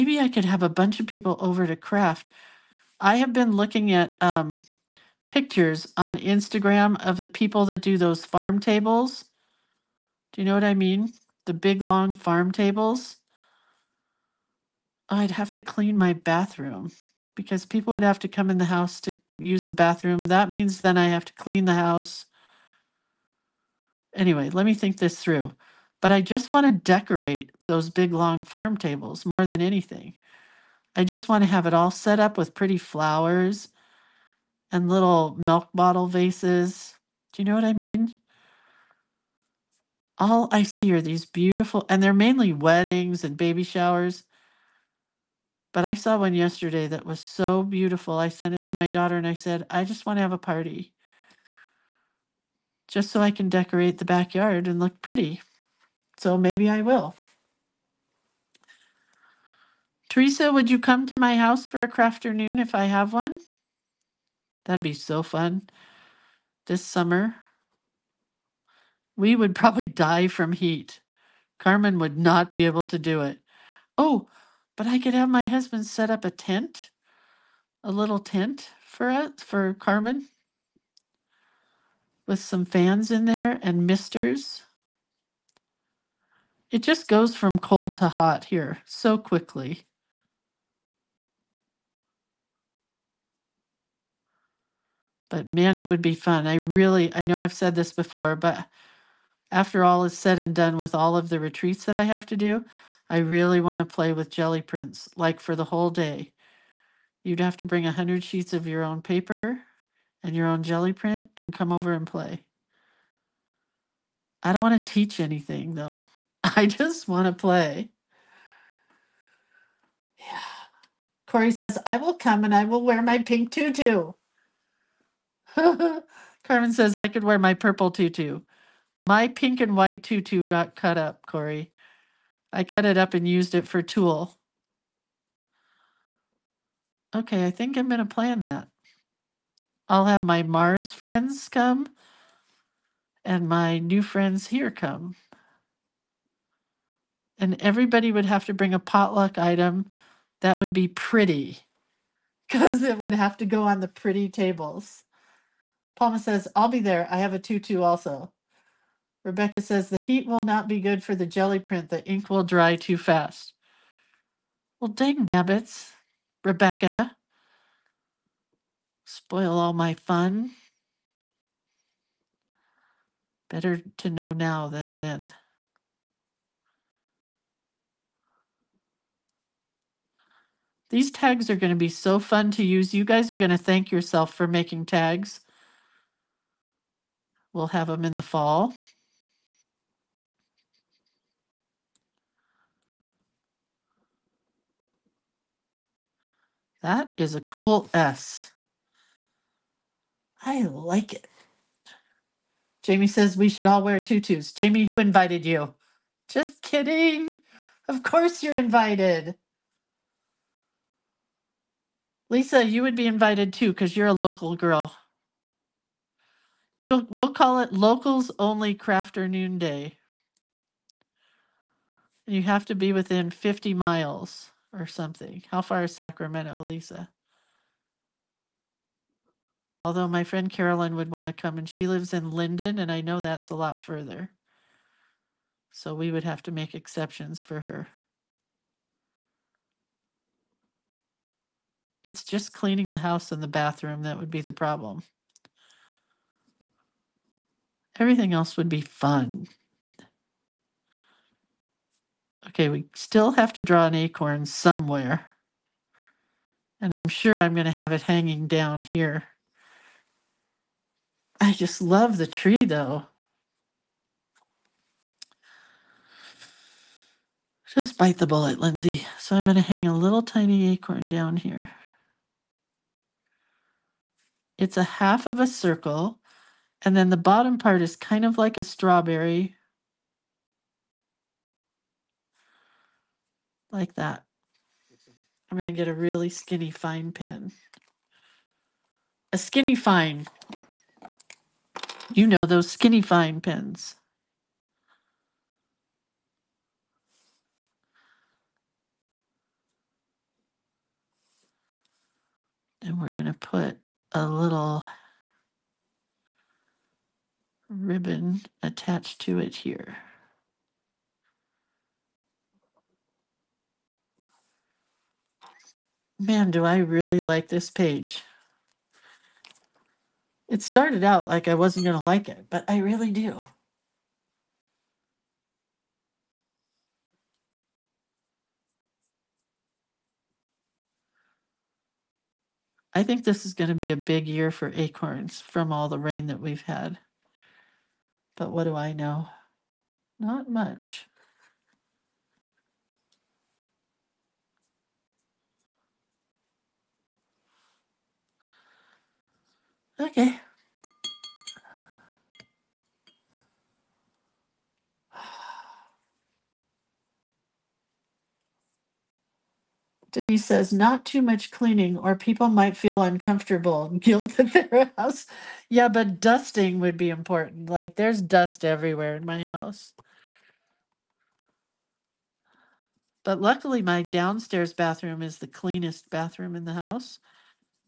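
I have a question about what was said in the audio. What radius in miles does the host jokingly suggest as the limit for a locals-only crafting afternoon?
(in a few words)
50 miles.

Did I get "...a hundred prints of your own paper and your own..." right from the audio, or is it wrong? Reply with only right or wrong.
wrong.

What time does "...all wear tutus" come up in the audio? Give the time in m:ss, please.
3:23.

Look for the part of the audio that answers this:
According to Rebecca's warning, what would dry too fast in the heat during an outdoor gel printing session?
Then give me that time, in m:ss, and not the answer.
2:41.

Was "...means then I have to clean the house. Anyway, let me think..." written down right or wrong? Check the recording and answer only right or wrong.
right.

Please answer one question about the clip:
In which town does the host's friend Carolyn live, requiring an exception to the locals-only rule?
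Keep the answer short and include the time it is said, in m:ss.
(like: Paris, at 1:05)
Linden, at 3:52.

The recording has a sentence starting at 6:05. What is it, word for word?
Yeah, but dusting would be important.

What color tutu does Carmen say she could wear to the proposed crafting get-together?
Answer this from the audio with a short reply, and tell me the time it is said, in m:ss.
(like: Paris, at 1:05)
purple, at 2:07.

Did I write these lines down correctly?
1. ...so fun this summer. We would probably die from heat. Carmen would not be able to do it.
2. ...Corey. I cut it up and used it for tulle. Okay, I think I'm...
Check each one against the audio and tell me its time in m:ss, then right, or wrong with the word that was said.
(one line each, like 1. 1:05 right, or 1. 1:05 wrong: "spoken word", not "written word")
1. 1:04 right
2. 2:11 right.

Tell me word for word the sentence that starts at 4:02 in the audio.
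It's just cleaning the house and the bathroom that would be the problem.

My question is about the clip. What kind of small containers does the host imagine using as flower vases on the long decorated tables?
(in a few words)
milk bottle vases.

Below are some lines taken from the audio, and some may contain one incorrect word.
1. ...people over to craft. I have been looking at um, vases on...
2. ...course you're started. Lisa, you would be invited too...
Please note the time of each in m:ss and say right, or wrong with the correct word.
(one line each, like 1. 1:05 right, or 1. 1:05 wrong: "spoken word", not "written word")
1. 0:01 wrong: "pictures", not "vases"
2. 3:28 wrong: "invited", not "started".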